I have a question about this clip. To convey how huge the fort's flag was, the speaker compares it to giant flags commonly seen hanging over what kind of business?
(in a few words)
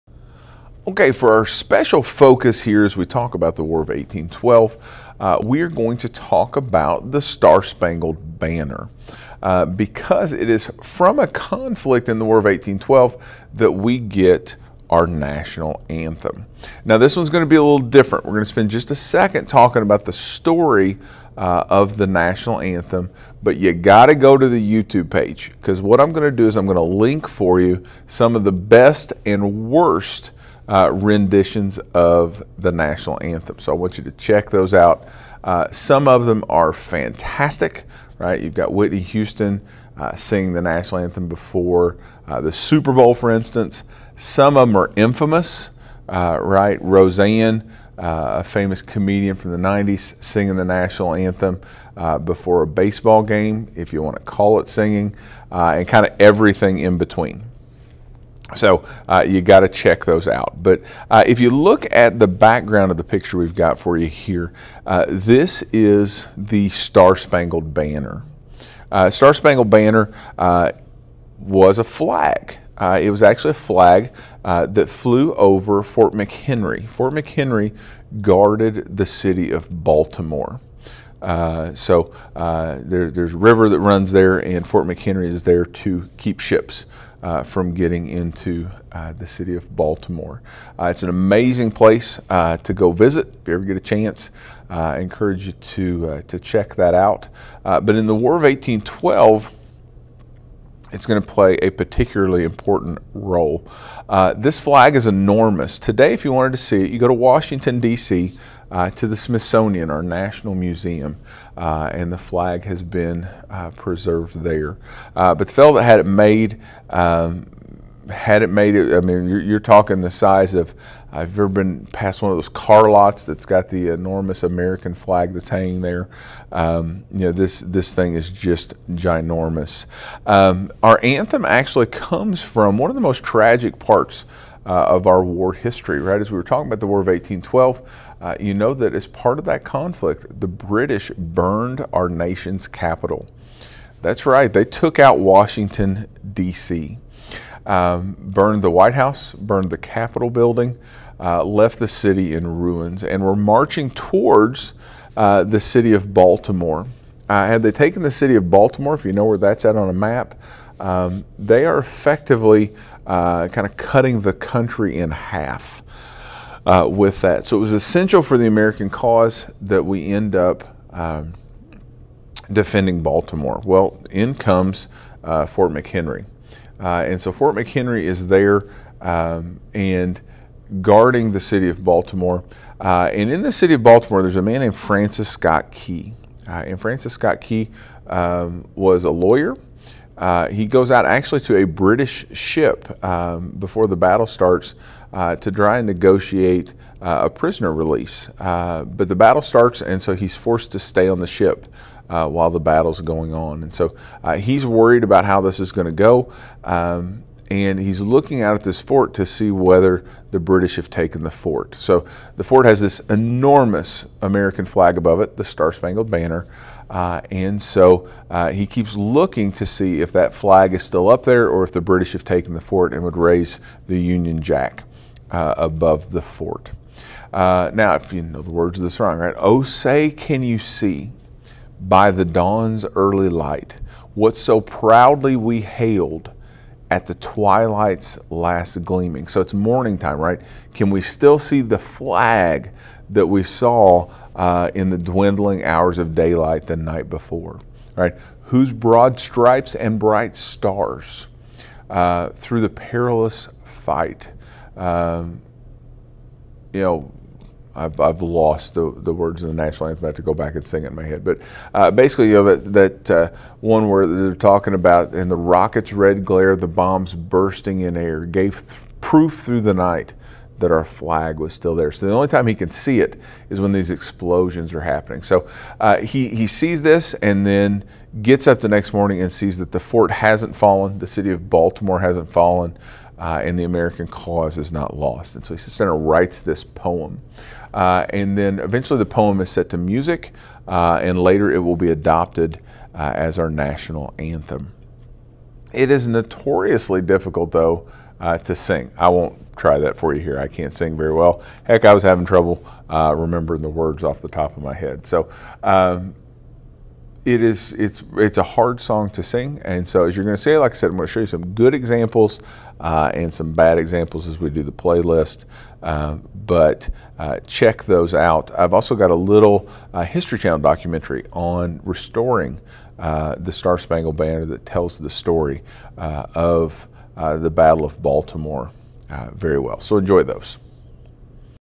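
Car lots.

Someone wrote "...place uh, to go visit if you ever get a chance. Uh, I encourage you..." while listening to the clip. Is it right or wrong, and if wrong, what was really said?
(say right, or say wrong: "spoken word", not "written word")
right.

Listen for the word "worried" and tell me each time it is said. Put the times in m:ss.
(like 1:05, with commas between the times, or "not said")
3:24.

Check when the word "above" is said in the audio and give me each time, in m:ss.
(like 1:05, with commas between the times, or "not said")
3:34, 3:45.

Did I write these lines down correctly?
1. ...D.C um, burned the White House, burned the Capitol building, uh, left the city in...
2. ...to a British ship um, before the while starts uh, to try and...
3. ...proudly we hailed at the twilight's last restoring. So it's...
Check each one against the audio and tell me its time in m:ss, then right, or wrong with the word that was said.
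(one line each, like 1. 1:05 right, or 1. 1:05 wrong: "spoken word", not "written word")
1. 2:26 right
2. 3:11 wrong: "battle", not "while"
3. 3:54 wrong: "gleaming", not "restoring".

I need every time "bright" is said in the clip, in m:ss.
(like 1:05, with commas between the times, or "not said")
4:09.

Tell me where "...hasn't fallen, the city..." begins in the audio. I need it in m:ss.
4:40.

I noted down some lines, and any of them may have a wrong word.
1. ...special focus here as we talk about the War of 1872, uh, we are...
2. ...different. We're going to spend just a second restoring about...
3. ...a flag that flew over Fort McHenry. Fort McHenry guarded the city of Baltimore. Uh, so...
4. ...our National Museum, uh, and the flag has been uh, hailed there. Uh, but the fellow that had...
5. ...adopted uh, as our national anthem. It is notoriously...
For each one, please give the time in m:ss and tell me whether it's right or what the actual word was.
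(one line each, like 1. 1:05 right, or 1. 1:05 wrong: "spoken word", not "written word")
1. 0:01 wrong: "1812", not "1872"
2. 0:17 wrong: "talking", not "restoring"
3. 1:13 right
4. 1:49 wrong: "preserved", not "hailed"
5. 4:51 right.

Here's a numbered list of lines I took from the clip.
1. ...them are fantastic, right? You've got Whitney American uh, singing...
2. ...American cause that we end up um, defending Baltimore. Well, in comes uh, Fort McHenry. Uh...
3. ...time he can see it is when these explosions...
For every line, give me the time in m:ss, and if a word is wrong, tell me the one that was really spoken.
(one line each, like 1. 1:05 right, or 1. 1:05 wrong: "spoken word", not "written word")
1. 0:36 wrong: "Houston", not "American"
2. 2:48 right
3. 4:32 right.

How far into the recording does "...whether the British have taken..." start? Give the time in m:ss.
3:29.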